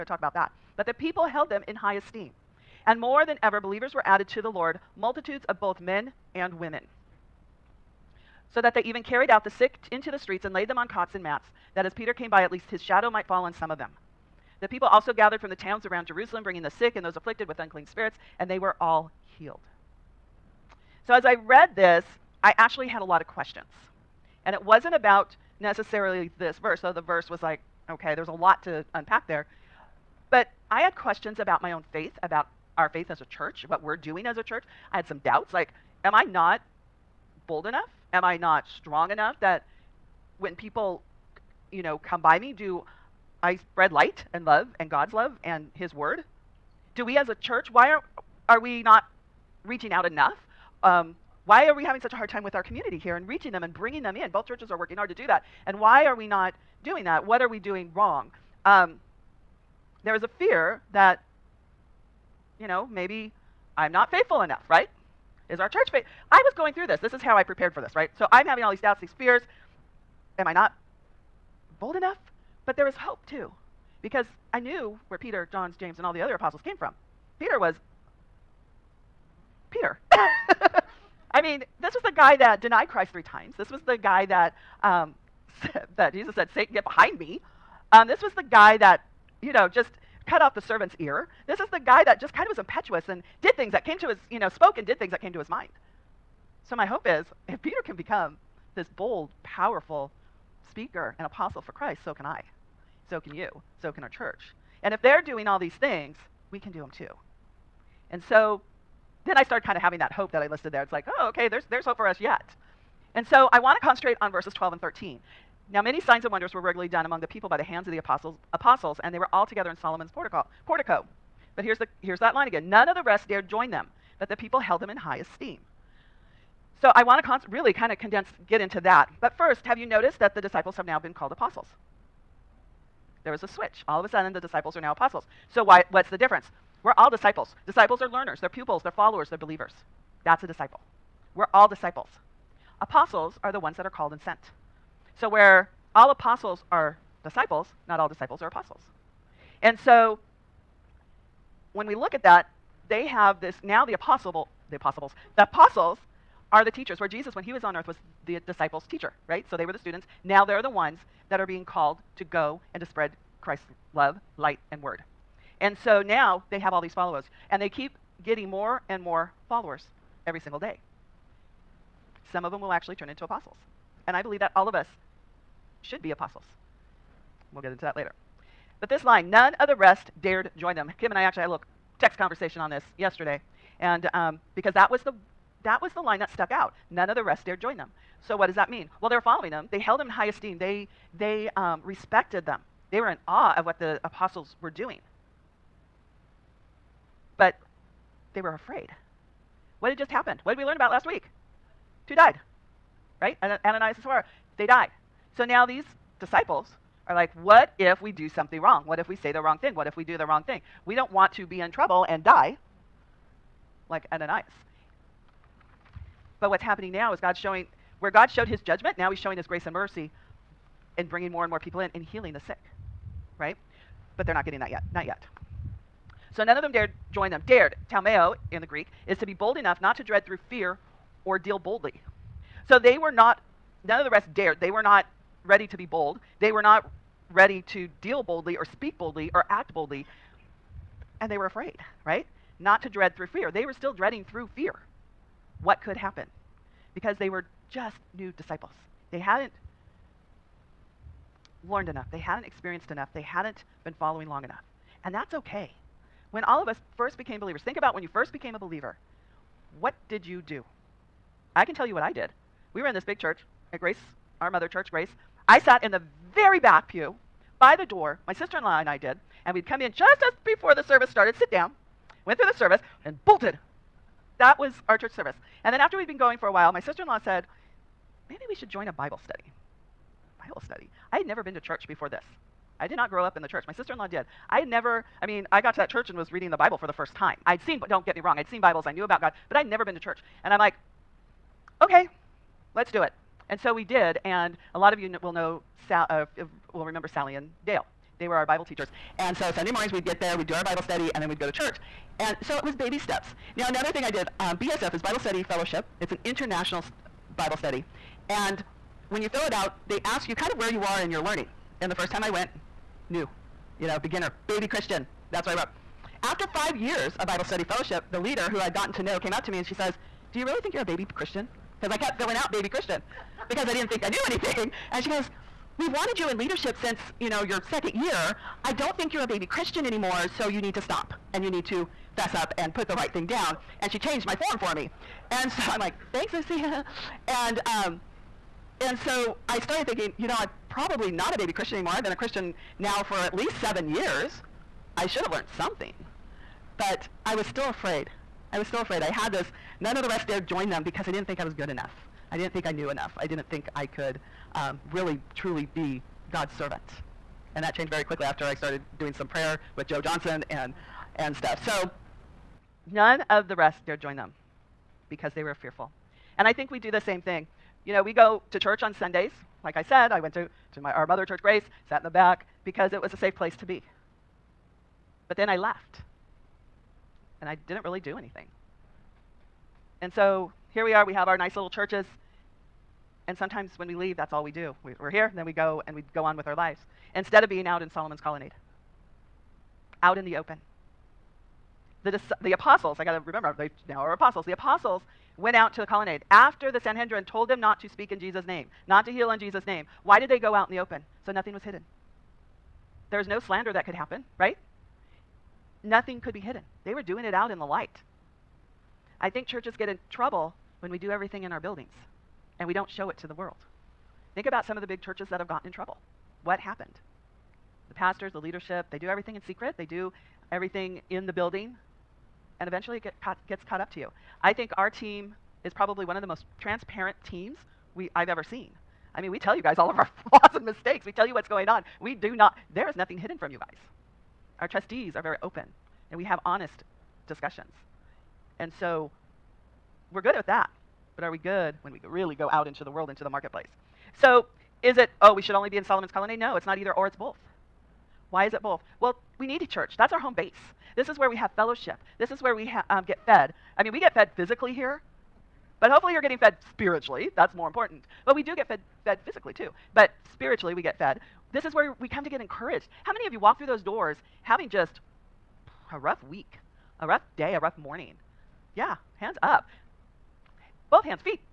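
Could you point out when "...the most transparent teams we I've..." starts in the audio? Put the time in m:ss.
7:06.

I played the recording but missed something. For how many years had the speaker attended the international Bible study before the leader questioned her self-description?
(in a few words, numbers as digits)
5.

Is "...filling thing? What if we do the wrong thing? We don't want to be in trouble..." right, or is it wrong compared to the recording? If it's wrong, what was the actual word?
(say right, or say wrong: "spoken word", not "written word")
wrong: "wrong", not "filling".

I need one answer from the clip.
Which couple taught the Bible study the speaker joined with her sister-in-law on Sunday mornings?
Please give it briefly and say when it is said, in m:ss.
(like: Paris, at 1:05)
Sally and Dale, at 4:57.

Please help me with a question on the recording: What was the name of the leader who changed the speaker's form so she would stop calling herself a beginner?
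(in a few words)
Lucy.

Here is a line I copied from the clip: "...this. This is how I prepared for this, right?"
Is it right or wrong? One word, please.
right.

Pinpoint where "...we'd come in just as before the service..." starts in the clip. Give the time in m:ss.
4:29.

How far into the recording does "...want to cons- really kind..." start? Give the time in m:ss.
2:07.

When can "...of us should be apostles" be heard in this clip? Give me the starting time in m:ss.
2:54.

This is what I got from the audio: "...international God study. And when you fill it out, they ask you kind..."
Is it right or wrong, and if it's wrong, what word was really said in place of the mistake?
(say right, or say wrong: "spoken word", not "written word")
wrong: "Bible", not "God".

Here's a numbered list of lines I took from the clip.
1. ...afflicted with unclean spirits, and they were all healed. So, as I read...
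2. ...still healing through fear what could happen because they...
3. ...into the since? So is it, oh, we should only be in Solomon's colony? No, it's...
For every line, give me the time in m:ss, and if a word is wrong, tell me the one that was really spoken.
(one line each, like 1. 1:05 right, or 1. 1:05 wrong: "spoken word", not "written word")
1. 0:17 right
2. 4:03 wrong: "dreading", not "healing"
3. 7:23 wrong: "marketplace", not "since".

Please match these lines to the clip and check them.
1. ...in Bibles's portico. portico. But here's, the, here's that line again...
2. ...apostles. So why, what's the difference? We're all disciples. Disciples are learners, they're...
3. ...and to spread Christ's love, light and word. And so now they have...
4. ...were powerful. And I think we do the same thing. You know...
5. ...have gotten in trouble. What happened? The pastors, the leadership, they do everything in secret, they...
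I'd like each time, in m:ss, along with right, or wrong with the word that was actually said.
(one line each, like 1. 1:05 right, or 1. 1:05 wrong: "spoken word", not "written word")
1. 1:59 wrong: "Solomon", not "Bibles"
2. 2:14 right
3. 2:42 right
4. 6:05 wrong: "fearful", not "powerful"
5. 6:55 right.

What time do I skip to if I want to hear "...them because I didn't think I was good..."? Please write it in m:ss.
5:50.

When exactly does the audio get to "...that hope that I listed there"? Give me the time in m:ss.
1:49.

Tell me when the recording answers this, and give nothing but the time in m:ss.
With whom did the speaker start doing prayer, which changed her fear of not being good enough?
5:59.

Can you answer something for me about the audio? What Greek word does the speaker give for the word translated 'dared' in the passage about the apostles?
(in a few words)
talmeo.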